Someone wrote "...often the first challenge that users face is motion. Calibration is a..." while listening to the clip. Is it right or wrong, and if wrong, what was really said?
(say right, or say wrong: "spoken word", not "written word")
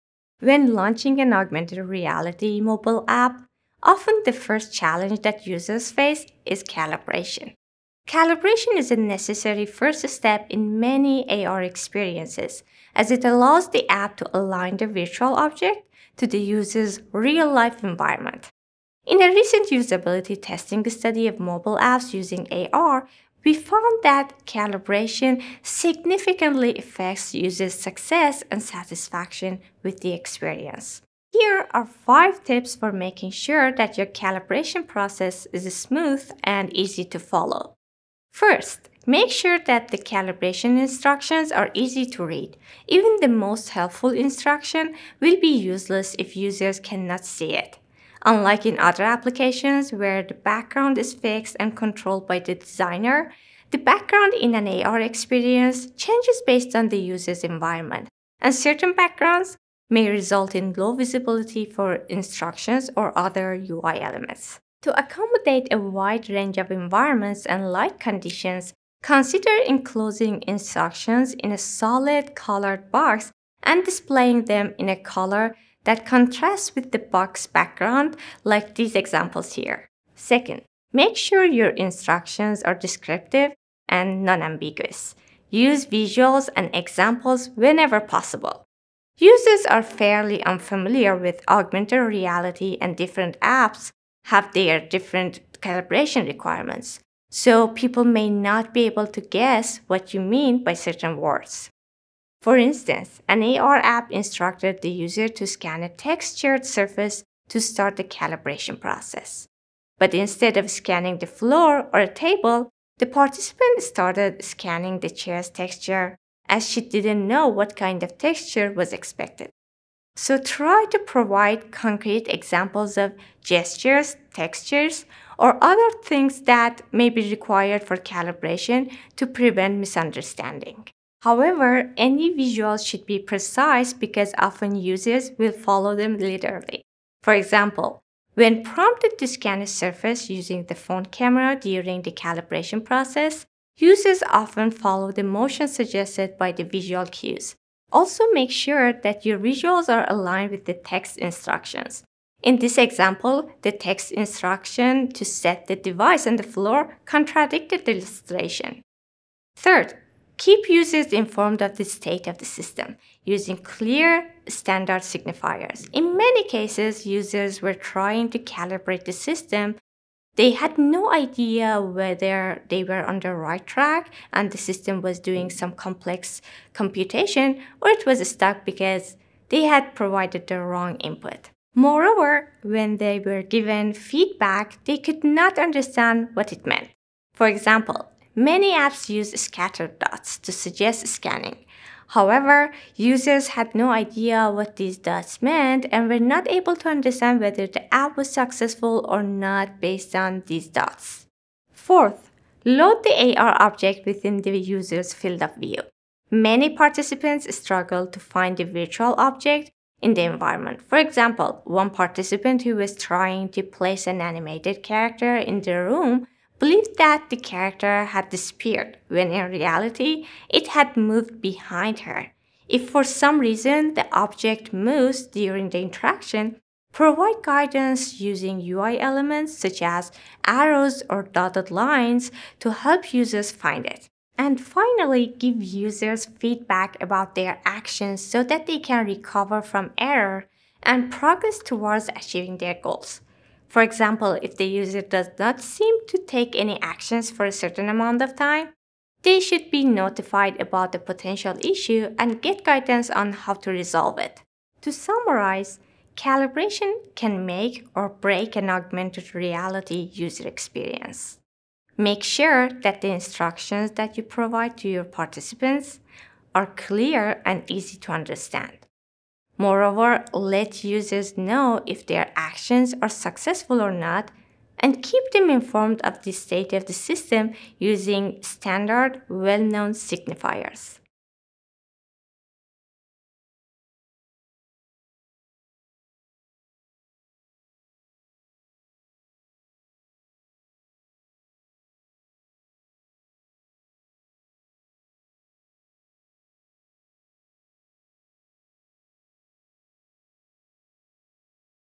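wrong: "calibration", not "motion".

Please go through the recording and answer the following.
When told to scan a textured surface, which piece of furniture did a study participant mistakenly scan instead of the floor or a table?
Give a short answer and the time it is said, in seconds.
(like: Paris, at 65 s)
the chair, at 115 s.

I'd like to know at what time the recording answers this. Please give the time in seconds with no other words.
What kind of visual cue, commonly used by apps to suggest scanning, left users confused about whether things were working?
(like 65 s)
189 s.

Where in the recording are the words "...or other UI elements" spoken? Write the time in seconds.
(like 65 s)
62 s.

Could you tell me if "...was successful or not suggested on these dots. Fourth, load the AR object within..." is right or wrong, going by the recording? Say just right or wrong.
wrong.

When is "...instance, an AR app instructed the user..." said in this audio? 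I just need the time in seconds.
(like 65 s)
102 s.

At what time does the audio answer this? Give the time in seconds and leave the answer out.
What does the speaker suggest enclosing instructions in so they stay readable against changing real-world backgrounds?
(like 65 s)
71 s.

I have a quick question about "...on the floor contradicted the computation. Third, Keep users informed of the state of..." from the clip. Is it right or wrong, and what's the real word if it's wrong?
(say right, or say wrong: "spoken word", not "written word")
wrong: "illustration", not "computation".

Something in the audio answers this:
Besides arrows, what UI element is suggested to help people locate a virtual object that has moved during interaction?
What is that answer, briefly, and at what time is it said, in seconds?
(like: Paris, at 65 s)
dotted lines, at 231 s.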